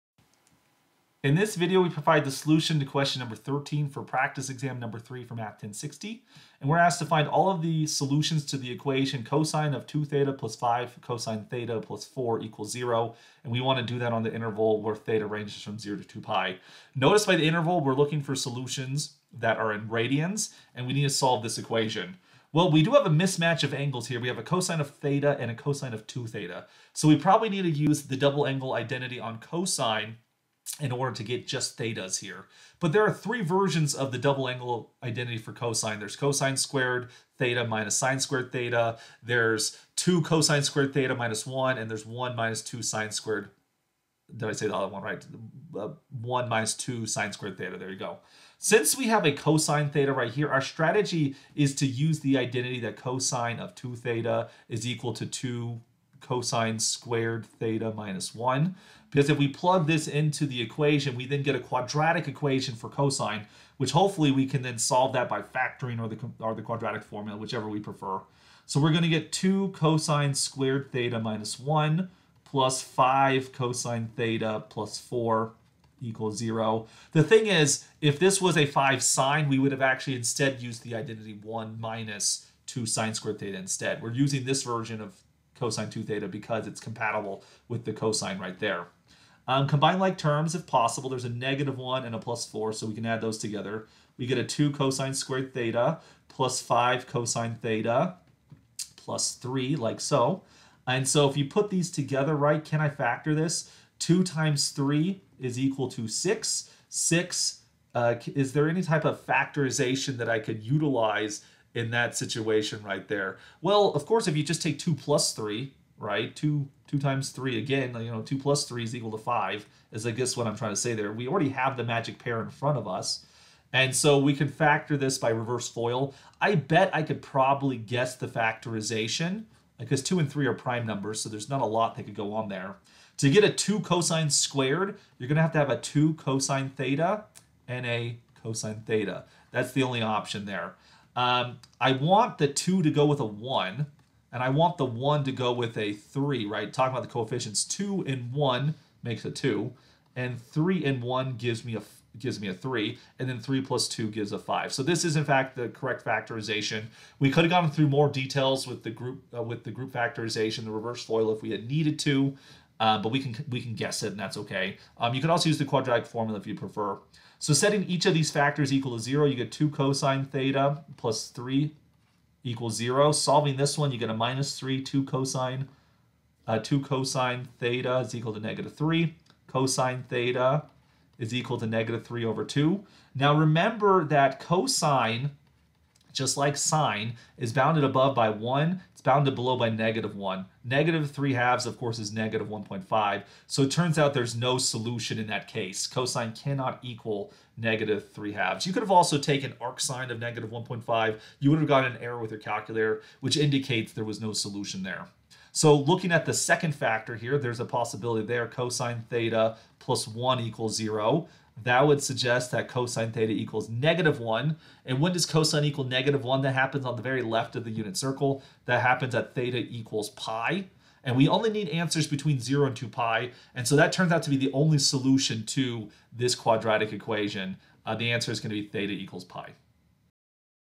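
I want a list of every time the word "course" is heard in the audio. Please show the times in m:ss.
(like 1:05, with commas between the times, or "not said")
1:54, 3:11.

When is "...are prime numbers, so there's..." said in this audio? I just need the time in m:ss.
2:10.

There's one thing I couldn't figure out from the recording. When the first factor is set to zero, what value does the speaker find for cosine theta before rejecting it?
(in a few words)
-3/2.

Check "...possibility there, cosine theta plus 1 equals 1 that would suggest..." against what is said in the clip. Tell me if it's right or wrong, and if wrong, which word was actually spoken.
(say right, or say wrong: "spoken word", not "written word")
wrong: "0", not "1".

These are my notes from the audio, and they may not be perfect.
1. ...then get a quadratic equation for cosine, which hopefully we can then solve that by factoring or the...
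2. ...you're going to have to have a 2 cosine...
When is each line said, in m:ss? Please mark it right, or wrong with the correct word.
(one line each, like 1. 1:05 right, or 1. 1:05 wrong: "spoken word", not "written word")
1. 1:01 right
2. 2:15 right.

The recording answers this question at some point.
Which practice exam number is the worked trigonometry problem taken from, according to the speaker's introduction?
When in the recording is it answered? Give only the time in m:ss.
0:04.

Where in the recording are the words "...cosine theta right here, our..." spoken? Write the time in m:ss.
0:49.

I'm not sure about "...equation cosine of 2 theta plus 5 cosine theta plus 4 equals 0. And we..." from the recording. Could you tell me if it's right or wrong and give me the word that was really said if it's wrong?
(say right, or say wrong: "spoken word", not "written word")
right.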